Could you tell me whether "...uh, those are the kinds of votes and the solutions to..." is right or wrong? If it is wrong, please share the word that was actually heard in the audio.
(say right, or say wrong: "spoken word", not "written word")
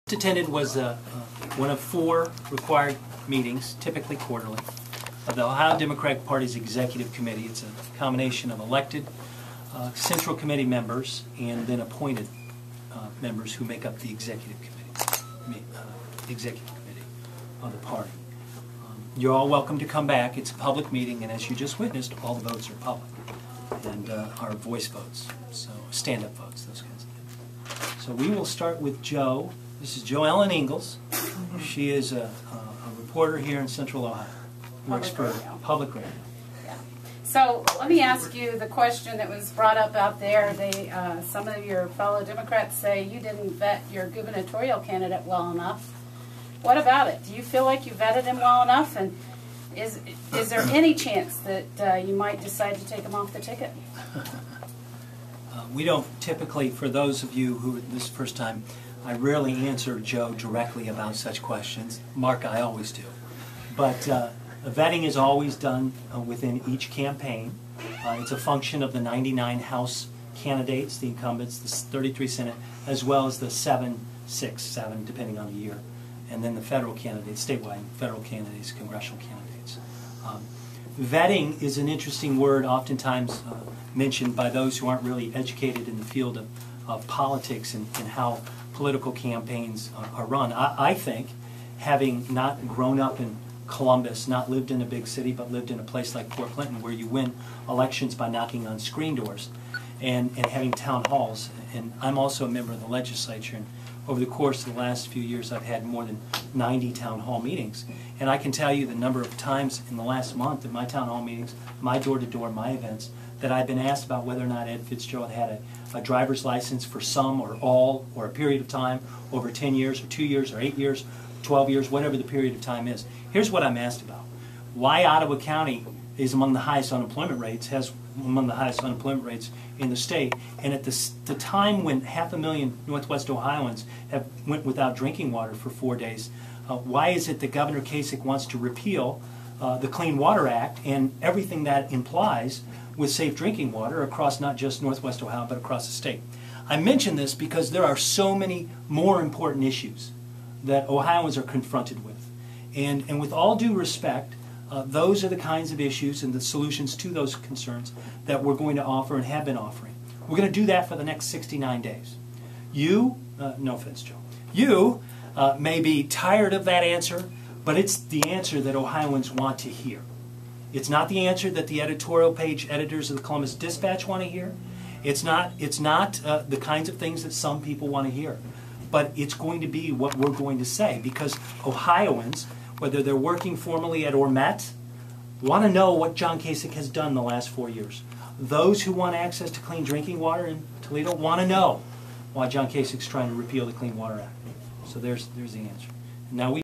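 wrong: "issues", not "votes".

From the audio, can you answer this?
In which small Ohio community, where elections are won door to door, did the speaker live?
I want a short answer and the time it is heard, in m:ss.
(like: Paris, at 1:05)
Port Clinton, at 1:36.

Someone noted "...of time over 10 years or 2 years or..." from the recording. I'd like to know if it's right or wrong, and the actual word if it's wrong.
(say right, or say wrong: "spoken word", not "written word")
right.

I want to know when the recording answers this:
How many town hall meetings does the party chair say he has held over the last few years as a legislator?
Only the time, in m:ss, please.
1:45.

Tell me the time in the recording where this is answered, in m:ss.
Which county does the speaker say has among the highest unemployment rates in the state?
2:05.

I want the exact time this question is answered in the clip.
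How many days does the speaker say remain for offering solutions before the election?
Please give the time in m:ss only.
2:41.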